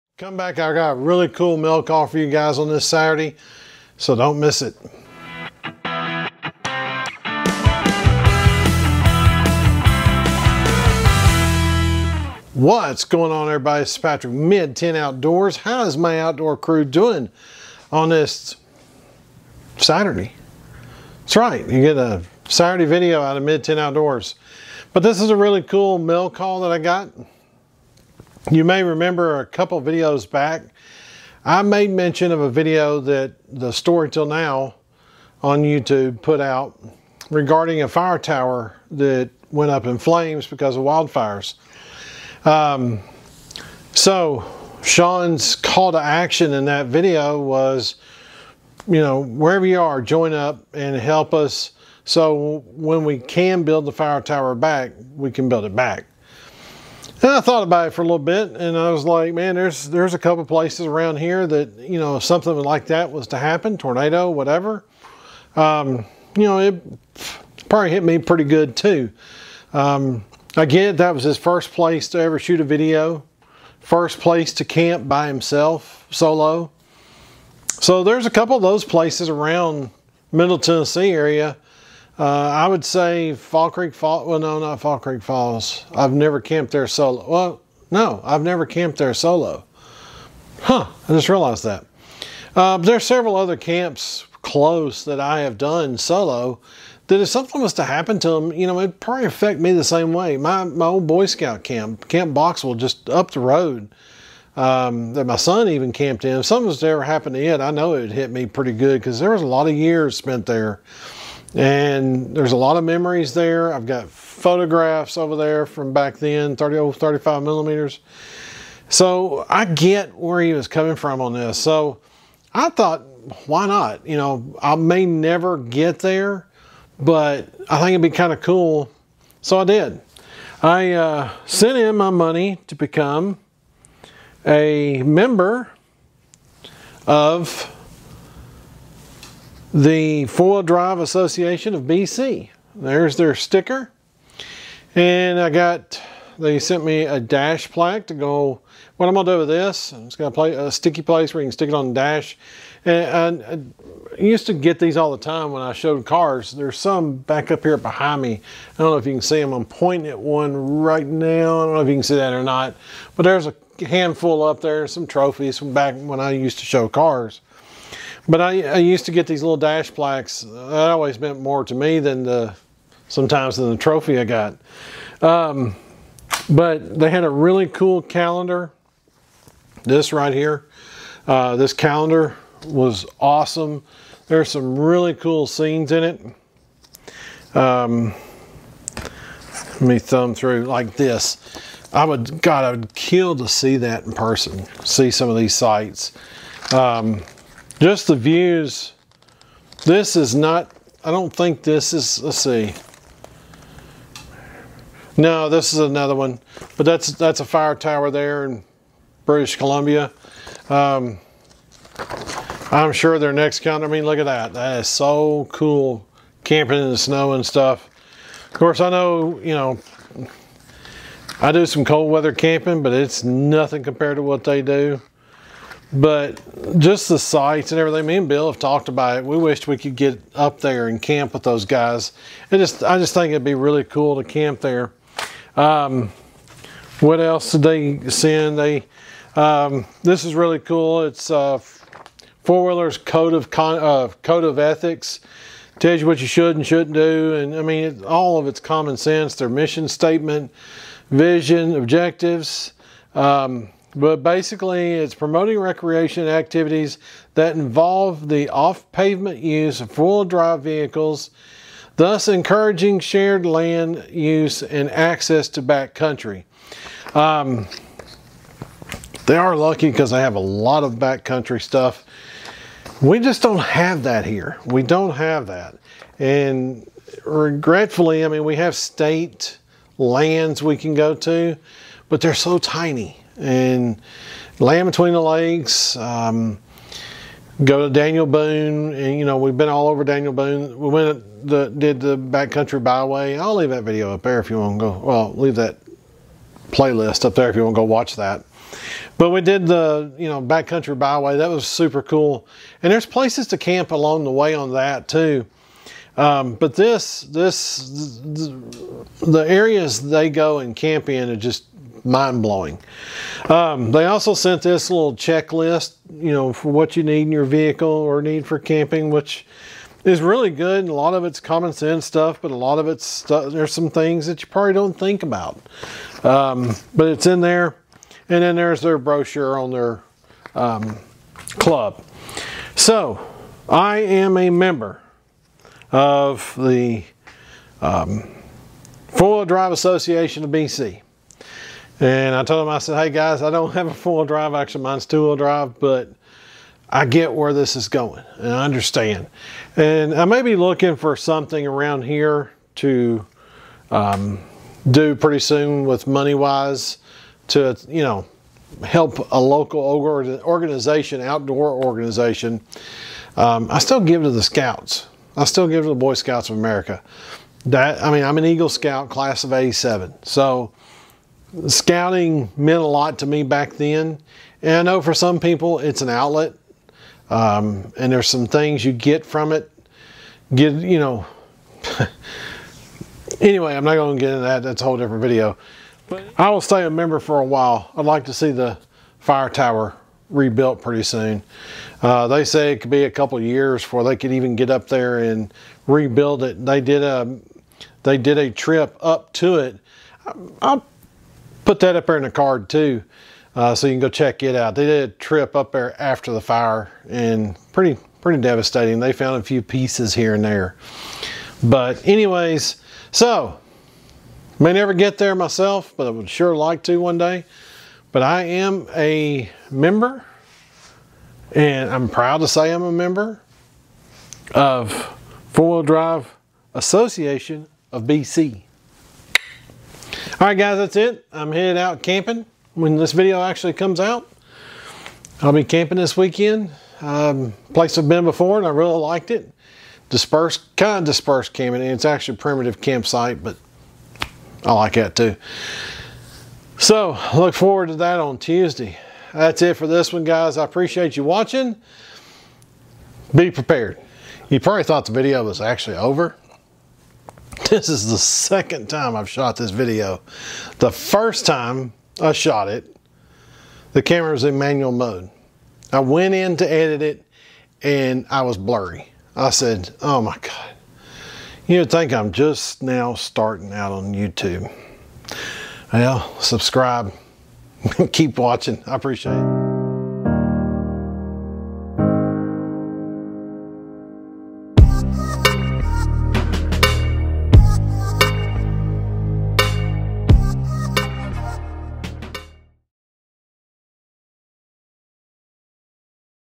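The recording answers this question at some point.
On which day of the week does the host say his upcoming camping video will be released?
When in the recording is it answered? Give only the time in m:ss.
7:28.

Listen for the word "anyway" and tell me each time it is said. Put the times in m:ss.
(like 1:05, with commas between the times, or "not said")
6:23, 6:52.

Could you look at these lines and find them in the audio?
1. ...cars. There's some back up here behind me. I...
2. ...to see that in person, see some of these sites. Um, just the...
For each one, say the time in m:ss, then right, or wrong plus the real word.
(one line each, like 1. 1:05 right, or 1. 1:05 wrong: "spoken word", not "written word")
1. 2:36 right
2. 3:13 right.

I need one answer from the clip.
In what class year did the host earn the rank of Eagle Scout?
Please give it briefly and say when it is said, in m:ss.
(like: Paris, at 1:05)
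1987, at 6:09.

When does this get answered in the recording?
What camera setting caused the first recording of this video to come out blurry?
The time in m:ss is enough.
7:44.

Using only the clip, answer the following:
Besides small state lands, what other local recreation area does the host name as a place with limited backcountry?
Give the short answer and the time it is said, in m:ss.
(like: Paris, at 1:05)
Land Between the Lakes, at 4:44.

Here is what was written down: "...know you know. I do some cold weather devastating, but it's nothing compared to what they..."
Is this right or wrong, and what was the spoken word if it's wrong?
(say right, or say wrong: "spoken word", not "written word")
wrong: "camping", not "devastating".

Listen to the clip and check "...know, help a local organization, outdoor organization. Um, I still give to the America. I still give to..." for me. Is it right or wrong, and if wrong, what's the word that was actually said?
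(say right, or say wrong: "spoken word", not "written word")
wrong: "Scouts", not "America".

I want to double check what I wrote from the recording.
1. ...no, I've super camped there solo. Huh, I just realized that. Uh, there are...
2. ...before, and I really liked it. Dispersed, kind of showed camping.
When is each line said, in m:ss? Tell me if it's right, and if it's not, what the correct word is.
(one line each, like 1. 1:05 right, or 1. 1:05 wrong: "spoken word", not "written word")
1. 1:27 wrong: "never", not "super"
2. 7:18 wrong: "dispersed", not "showed".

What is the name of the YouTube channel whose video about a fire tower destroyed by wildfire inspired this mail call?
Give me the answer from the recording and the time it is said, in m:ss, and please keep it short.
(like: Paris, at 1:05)
The Story Till Now, at 0:33.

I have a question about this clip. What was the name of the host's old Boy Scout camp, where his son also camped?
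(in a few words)
Camp Boxwell.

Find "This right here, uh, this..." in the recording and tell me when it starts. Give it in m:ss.
2:59.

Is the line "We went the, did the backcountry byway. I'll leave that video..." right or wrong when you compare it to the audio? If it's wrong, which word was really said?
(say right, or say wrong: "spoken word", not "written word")
right.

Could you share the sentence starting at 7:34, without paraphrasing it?
You probably thought the video was actually over.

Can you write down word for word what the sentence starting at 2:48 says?
But I, I used to get these little dash plaques.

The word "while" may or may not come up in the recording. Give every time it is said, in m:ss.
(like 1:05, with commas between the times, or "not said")
6:27.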